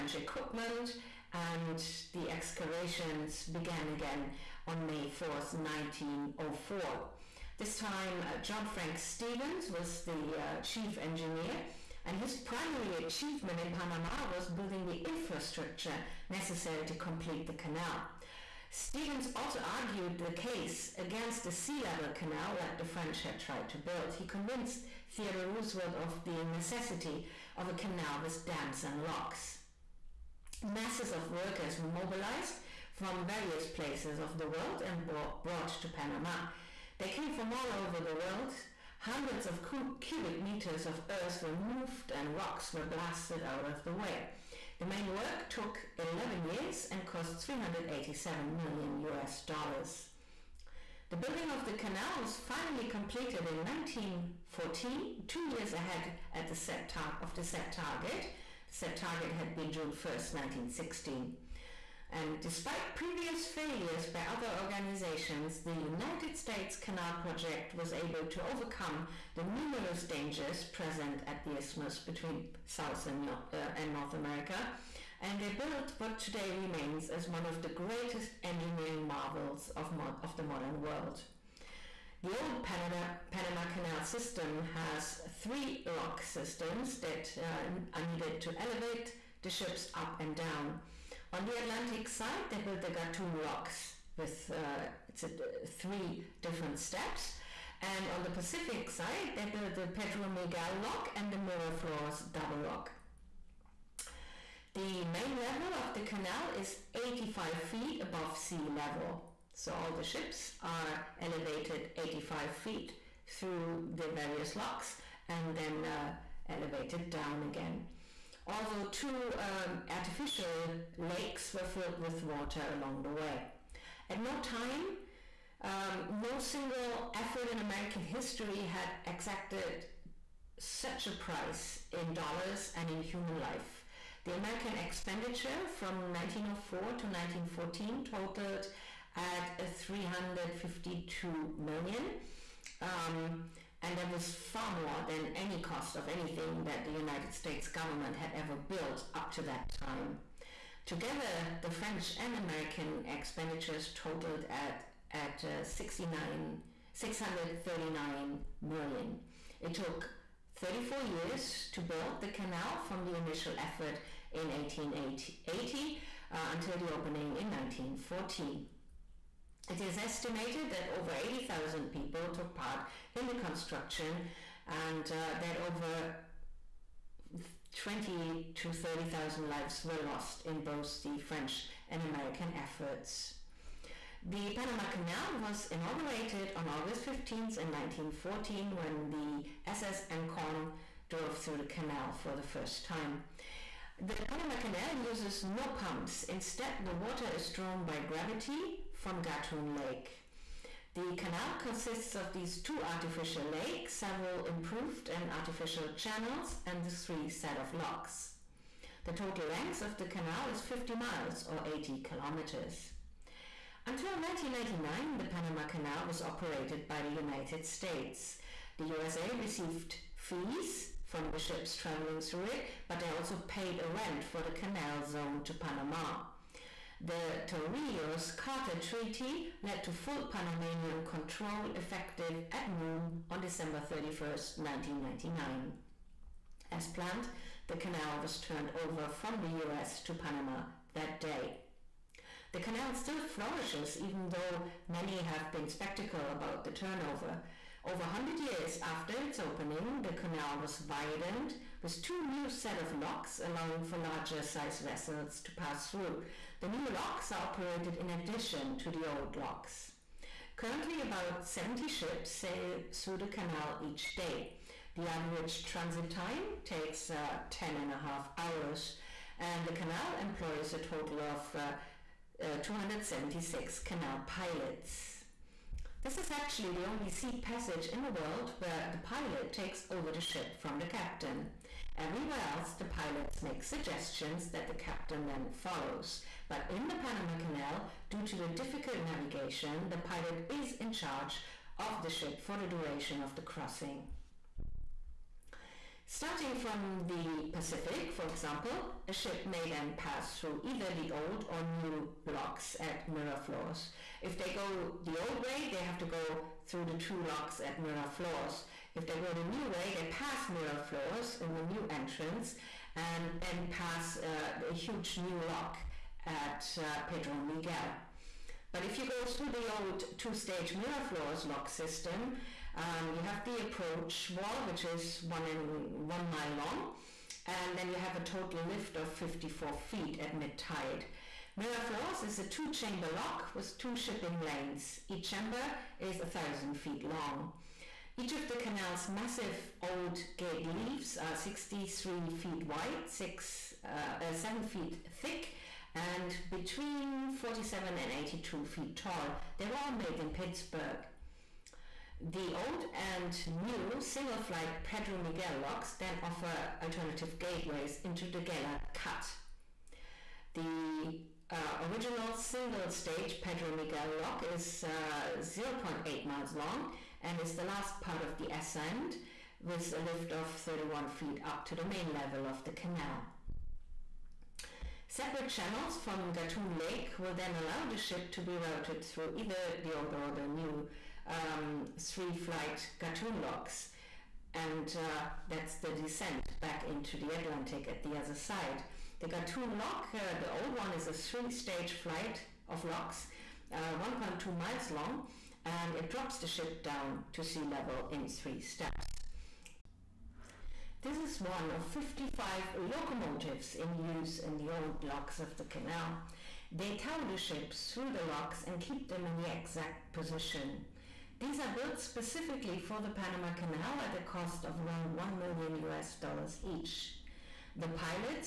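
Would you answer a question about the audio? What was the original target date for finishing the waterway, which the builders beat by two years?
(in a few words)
June 1st, 1916.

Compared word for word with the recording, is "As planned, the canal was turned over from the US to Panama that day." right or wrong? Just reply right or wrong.
right.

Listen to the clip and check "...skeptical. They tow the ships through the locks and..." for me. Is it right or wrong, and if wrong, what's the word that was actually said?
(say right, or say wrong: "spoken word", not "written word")
wrong: "canal", not "skeptical".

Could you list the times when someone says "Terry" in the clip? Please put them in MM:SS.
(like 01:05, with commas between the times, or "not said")
not said.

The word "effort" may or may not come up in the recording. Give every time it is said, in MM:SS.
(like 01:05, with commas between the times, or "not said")
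02:07, 02:43, 03:02.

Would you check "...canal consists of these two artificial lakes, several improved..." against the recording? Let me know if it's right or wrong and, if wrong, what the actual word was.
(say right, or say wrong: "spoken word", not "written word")
right.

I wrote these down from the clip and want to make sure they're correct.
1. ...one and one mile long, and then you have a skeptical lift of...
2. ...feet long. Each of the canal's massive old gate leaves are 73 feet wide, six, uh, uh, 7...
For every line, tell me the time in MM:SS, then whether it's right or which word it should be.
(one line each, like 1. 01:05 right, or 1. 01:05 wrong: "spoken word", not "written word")
1. 05:25 wrong: "total", not "skeptical"
2. 05:36 wrong: "63", not "73".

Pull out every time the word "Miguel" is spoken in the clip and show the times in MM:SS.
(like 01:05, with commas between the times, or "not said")
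01:40, 05:17, 05:55, 06:03.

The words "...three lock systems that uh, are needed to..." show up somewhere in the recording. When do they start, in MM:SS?
01:25.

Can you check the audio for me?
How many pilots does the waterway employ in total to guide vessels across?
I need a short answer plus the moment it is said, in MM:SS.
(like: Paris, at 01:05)
276, at 04:32.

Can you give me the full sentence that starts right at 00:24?
He convinced Theodore Roosevelt of the necessity of a canal with dams and locks.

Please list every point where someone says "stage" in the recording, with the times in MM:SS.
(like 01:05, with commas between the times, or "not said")
05:20, 06:02, 06:31.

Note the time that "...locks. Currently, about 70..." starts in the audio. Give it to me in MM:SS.
04:19.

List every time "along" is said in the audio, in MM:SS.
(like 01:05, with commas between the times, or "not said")
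02:02.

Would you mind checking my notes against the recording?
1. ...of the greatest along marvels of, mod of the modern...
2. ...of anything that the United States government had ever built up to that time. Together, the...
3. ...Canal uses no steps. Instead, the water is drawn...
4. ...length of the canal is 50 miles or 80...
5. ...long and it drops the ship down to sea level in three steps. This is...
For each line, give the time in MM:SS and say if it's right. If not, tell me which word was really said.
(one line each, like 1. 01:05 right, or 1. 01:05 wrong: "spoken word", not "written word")
1. 01:17 wrong: "engineering", not "along"
2. 02:25 right
3. 03:14 wrong: "pumps", not "steps"
4. 03:29 right
5. 06:34 right.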